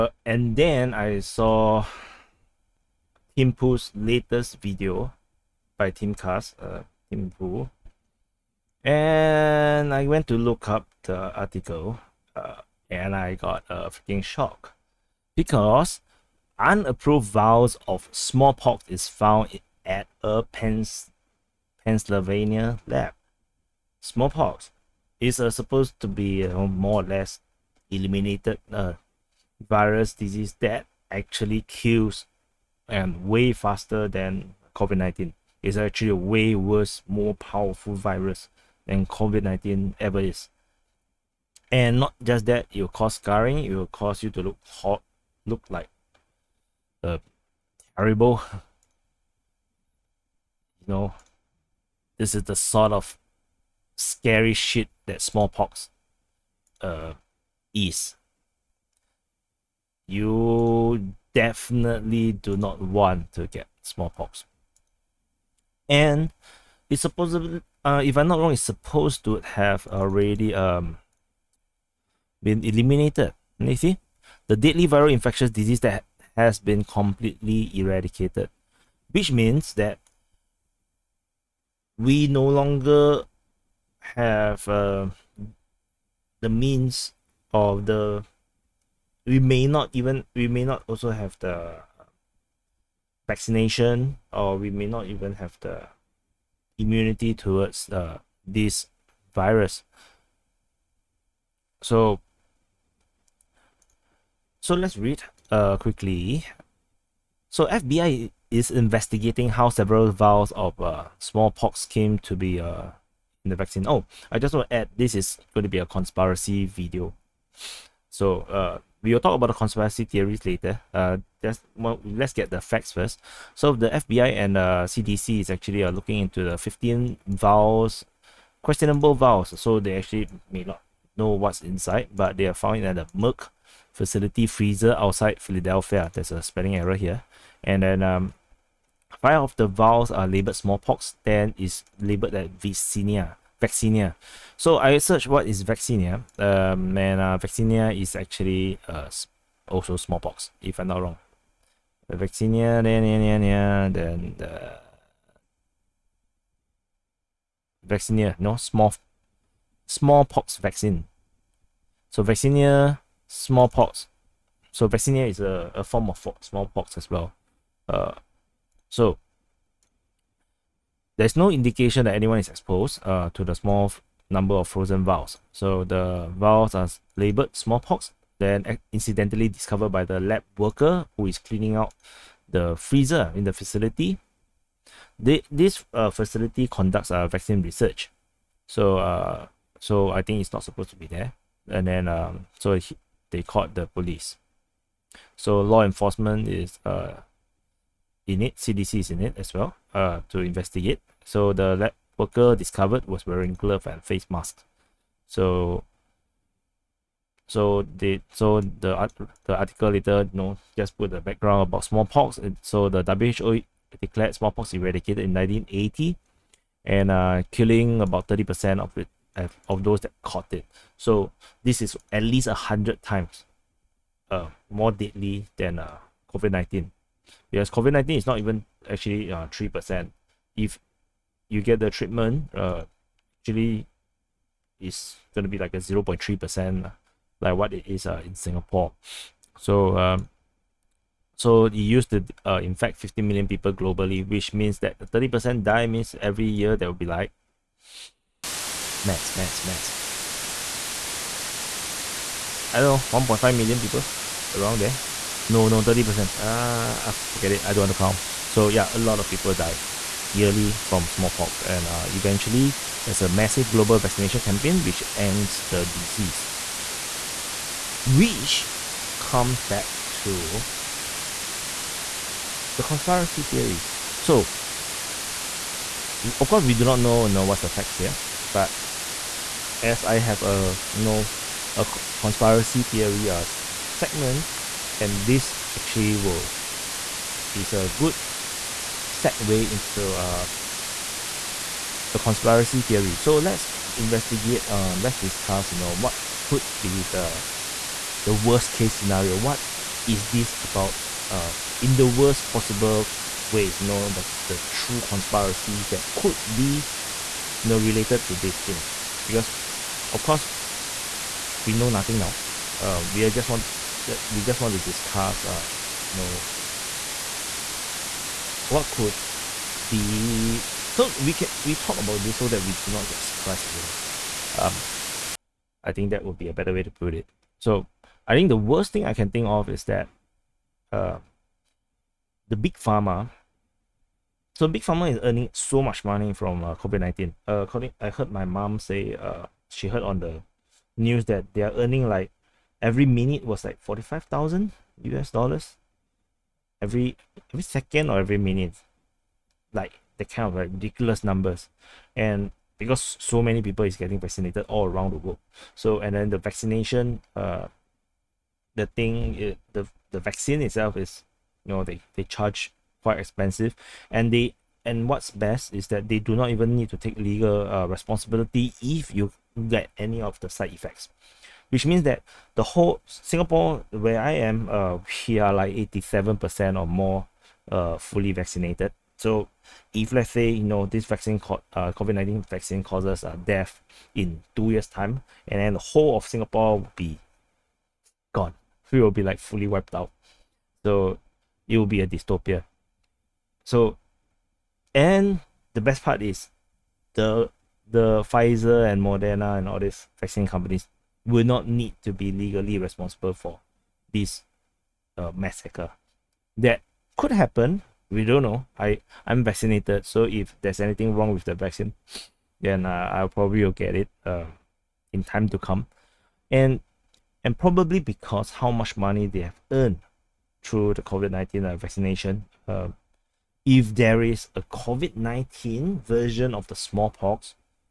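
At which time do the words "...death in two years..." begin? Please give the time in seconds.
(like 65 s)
383 s.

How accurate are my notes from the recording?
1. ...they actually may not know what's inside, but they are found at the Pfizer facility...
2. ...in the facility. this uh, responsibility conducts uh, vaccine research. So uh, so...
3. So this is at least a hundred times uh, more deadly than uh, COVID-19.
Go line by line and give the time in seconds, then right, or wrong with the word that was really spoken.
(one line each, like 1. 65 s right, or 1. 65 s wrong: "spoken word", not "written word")
1. 129 s wrong: "Merck", not "Pfizer"
2. 183 s wrong: "facility", not "responsibility"
3. 220 s right.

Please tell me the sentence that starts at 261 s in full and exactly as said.
And uh, eventually, there's a massive global vaccination campaign which ends the disease.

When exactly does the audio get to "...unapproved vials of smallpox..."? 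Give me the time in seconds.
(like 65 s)
16 s.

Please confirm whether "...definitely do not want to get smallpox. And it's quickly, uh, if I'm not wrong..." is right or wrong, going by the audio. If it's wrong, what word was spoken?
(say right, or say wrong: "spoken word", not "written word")
wrong: "supposedly", not "quickly".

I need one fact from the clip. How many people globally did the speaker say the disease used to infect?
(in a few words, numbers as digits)
50 million.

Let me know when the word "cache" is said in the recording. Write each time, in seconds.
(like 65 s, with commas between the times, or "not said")
not said.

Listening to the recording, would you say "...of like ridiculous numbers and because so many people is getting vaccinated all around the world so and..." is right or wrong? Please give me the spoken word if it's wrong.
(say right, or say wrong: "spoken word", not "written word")
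right.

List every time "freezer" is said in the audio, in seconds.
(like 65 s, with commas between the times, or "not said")
134 s, 182 s.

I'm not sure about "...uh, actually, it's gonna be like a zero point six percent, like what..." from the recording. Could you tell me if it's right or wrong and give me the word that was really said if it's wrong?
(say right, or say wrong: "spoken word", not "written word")
wrong: "three", not "six".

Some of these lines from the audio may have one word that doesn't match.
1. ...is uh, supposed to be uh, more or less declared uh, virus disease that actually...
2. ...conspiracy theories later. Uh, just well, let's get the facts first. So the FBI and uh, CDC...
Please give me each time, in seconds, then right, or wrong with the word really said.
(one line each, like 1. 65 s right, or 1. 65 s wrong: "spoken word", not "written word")
1. 25 s wrong: "eliminated", not "declared"
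2. 119 s right.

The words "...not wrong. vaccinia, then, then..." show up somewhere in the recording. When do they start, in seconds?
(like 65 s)
150 s.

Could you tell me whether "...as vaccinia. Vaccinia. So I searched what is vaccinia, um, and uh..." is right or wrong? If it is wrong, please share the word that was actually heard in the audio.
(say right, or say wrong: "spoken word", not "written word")
right.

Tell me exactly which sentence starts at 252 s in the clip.
I don't know, 1.5 million people around there.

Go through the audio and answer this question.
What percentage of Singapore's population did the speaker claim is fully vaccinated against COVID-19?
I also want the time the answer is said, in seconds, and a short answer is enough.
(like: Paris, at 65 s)
87%, at 375 s.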